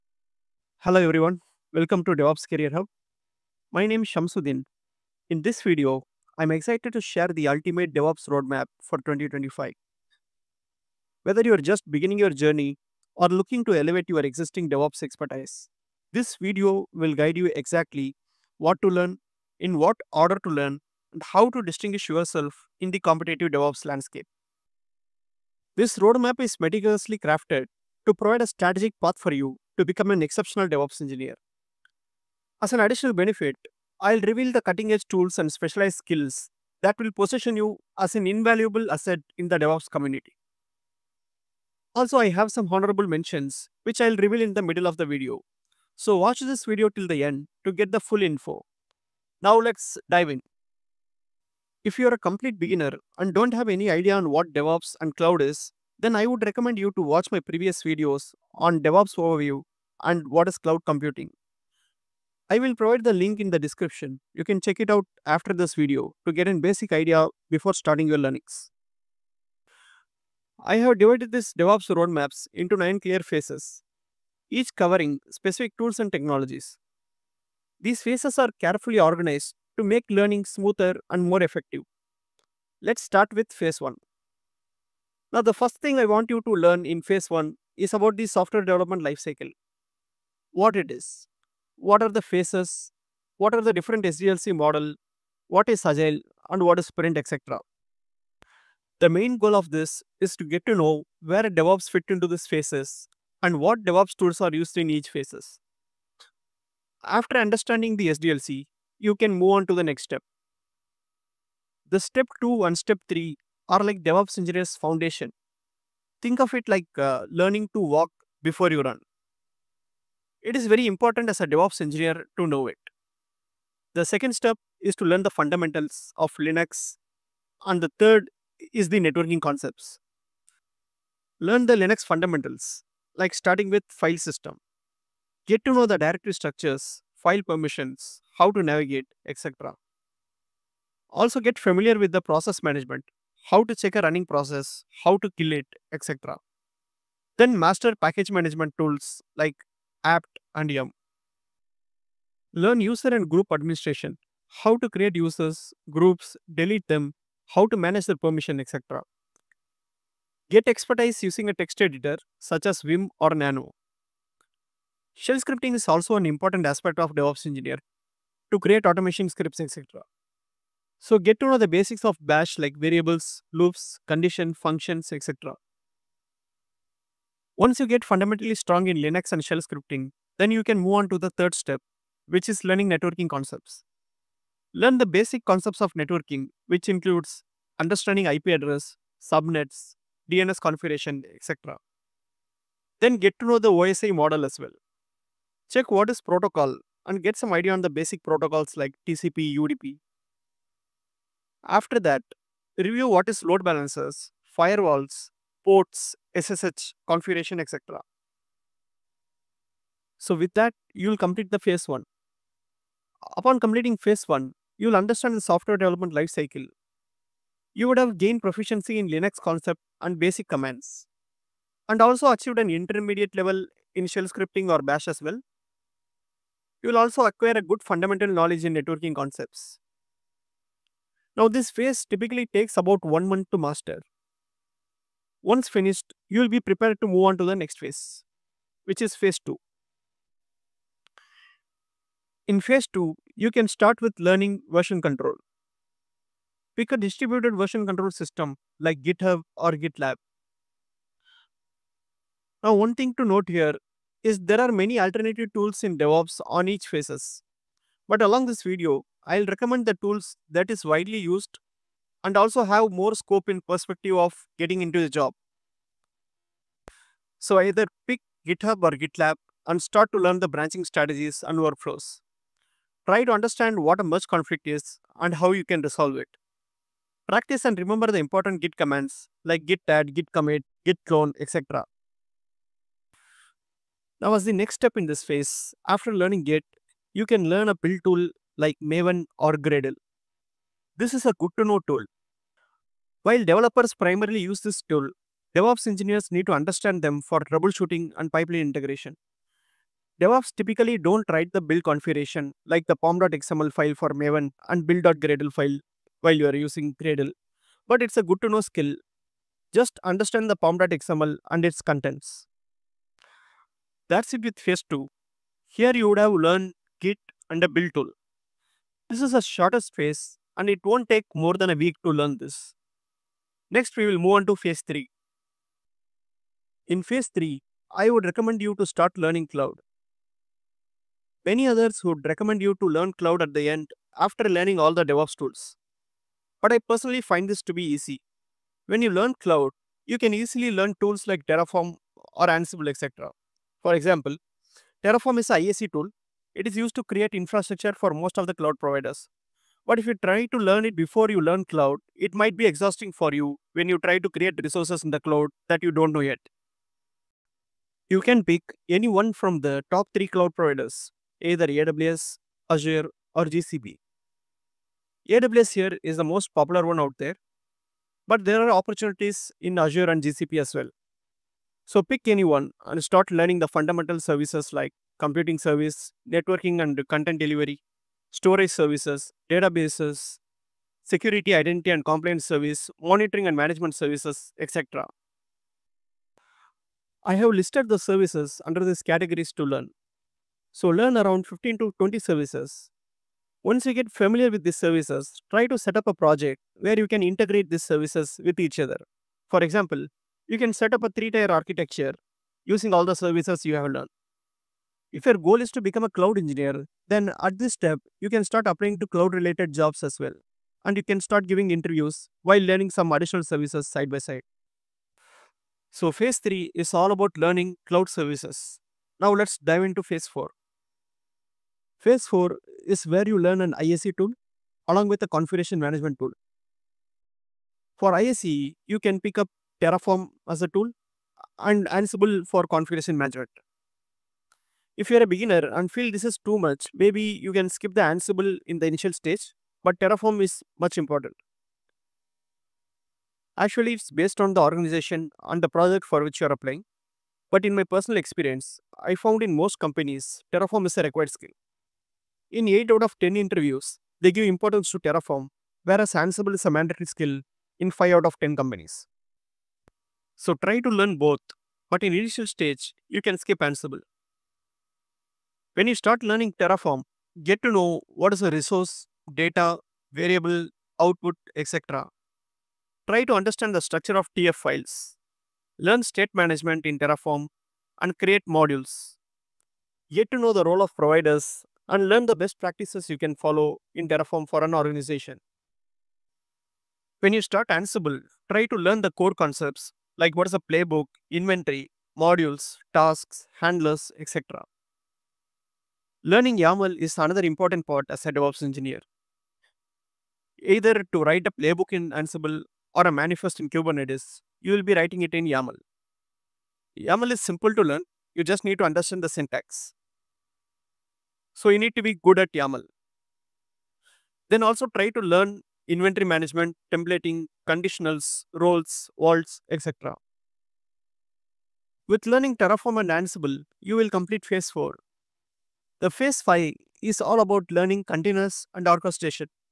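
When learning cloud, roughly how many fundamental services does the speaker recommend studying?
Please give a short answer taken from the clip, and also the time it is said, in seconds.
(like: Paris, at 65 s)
15 to 20, at 391 s.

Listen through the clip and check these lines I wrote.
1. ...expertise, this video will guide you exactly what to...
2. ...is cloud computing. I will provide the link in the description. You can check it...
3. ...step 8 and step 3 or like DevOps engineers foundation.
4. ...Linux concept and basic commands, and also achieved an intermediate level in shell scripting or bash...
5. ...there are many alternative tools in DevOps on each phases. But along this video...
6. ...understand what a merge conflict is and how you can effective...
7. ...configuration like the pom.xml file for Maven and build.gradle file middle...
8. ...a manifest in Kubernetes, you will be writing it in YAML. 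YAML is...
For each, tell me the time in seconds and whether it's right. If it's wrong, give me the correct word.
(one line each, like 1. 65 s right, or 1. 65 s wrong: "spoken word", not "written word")
1. 15 s right
2. 60 s right
3. 112 s wrong: "2", not "8"
4. 219 s right
5. 254 s right
6. 273 s wrong: "resolve", not "effective"
7. 301 s wrong: "while", not "middle"
8. 503 s right.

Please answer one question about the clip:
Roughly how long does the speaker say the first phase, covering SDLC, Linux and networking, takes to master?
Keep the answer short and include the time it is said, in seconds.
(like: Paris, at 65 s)
One month, at 233 s.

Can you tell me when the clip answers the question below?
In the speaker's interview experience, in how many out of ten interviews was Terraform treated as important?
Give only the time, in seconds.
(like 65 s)
452 s.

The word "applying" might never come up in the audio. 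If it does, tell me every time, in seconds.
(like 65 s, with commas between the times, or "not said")
408 s, 446 s.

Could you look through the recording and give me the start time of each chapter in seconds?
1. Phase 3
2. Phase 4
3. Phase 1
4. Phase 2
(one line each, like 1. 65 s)
1. 326 s
2. 421 s
3. 86 s
4. 239 s.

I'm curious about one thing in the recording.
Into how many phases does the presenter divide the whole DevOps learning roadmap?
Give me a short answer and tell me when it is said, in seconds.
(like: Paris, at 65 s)
9, at 72 s.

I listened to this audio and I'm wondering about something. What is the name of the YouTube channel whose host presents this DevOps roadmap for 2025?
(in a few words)
DevOps Career Hub.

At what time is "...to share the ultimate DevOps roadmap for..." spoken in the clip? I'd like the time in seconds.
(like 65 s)
6 s.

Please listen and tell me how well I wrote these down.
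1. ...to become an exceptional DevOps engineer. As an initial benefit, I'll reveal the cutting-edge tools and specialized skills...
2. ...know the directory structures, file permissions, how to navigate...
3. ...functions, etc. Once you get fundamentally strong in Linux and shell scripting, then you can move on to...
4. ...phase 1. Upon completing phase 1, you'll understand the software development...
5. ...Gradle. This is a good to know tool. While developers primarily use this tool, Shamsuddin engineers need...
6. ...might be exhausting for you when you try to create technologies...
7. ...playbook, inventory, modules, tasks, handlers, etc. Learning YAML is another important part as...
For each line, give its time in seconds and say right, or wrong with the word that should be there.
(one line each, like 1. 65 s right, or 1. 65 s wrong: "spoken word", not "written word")
1. 29 s wrong: "additional", not "initial"
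2. 135 s right
3. 174 s right
4. 211 s right
5. 289 s wrong: "DevOps", not "Shamsuddin"
6. 352 s wrong: "resources", not "technologies"
7. 490 s right.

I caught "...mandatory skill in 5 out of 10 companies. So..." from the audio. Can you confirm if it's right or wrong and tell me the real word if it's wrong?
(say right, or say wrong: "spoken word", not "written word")
right.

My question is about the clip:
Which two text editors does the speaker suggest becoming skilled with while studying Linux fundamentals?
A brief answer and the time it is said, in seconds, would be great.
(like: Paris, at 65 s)
Vim or Nano, at 162 s.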